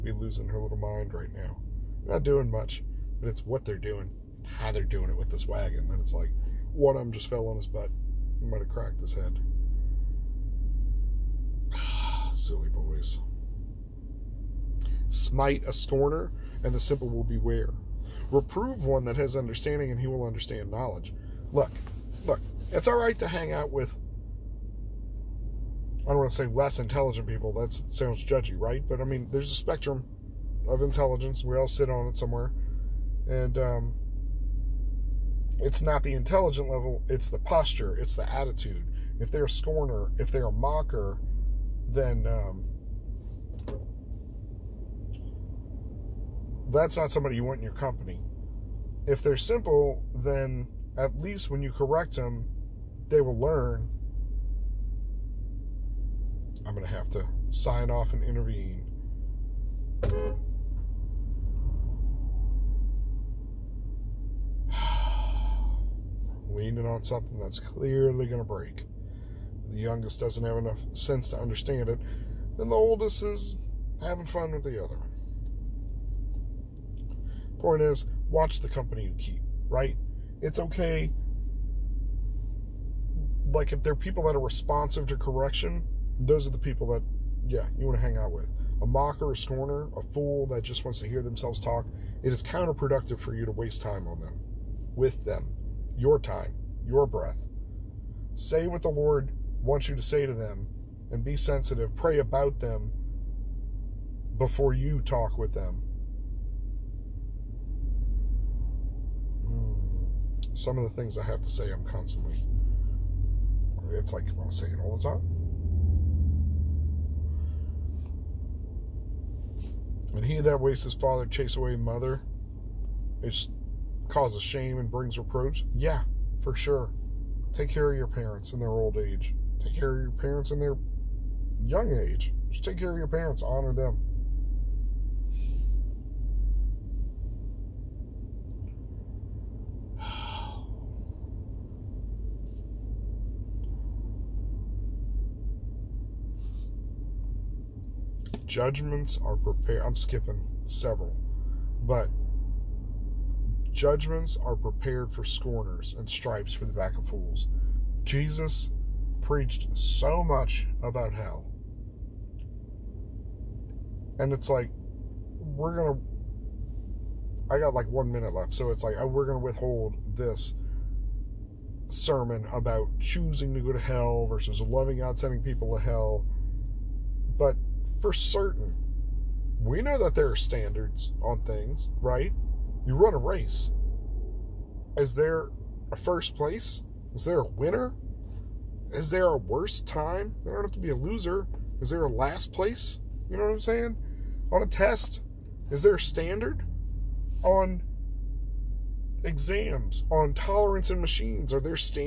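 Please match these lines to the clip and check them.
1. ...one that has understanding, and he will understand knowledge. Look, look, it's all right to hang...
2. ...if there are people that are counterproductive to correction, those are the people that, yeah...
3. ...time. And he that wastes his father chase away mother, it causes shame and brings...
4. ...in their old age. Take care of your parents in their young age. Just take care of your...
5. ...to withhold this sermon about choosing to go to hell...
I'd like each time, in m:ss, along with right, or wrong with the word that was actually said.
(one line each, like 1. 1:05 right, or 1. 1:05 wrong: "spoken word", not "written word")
1. 0:18 right
2. 1:23 wrong: "responsive", not "counterproductive"
3. 1:55 right
4. 2:08 right
5. 2:49 right.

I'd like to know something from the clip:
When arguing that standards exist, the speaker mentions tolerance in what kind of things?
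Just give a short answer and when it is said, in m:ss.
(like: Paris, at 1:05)
machines, at 3:20.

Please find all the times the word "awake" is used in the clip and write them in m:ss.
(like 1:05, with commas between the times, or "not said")
not said.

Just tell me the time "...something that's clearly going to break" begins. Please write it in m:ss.
1:07.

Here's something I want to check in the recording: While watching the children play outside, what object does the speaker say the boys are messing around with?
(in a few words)
wagon.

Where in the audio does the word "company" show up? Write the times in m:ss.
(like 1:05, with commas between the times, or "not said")
0:47, 1:18.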